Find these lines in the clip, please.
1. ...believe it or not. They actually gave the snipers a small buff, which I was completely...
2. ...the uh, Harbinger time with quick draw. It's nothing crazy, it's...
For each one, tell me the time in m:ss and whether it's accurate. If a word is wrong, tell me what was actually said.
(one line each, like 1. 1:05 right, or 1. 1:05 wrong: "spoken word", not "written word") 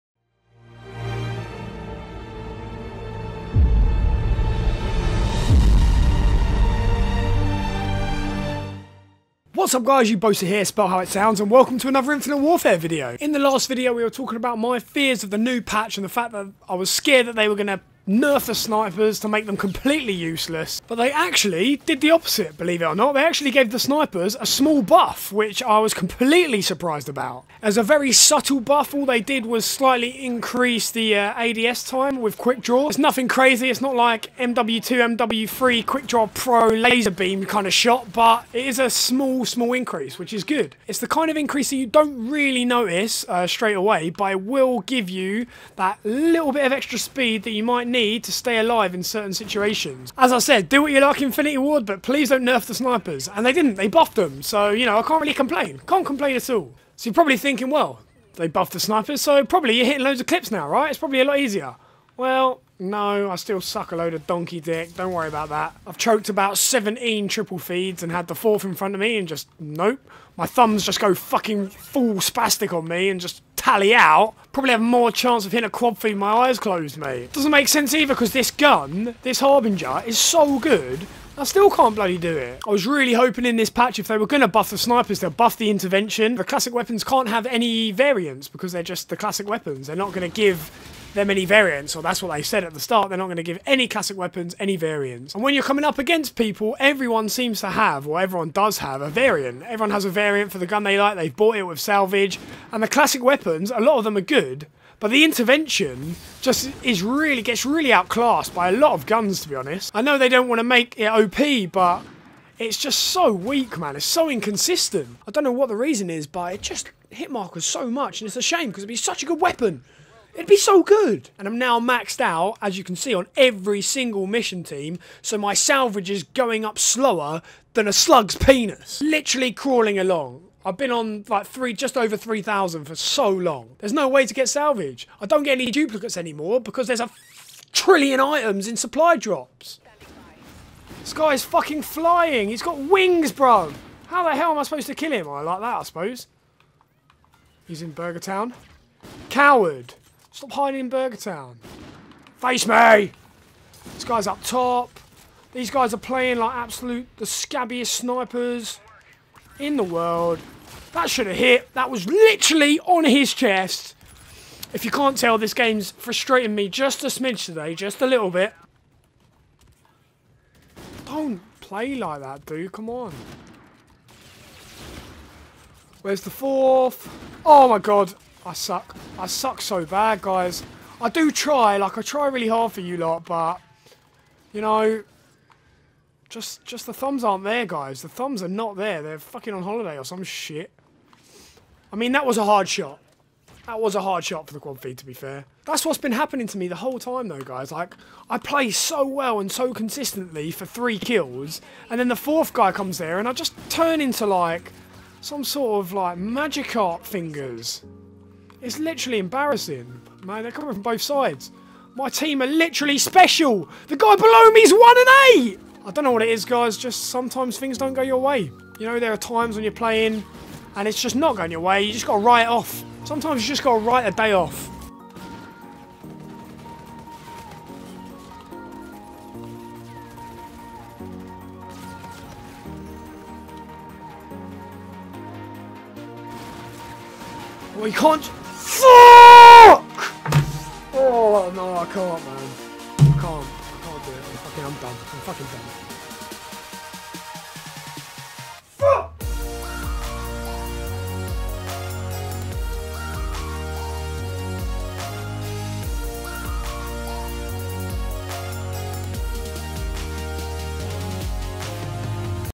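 1. 0:22 right
2. 0:30 wrong: "ADS", not "Harbinger".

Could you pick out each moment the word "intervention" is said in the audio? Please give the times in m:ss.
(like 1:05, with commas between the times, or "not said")
1:25, 1:45.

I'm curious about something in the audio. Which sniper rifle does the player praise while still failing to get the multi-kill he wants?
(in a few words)
Harbinger.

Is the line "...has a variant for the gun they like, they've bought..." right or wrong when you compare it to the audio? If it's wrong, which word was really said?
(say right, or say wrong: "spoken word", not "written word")
right.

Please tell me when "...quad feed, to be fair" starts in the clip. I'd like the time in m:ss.
3:14.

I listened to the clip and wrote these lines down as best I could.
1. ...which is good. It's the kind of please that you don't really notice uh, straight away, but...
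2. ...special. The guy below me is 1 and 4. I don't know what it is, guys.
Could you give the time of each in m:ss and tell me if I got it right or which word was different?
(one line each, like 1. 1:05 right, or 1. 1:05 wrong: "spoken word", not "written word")
1. 0:40 wrong: "increase", not "please"
2. 3:32 wrong: "8", not "4".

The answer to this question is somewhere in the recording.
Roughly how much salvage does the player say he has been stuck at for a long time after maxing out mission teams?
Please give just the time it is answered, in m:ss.
2:12.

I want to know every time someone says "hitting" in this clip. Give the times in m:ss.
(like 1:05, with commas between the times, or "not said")
0:59, 1:15.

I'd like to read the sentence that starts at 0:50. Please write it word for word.
As I said, do what you like Infinity Ward, but please don't nerf the snipers.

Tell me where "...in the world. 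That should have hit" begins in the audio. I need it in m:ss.
2:39.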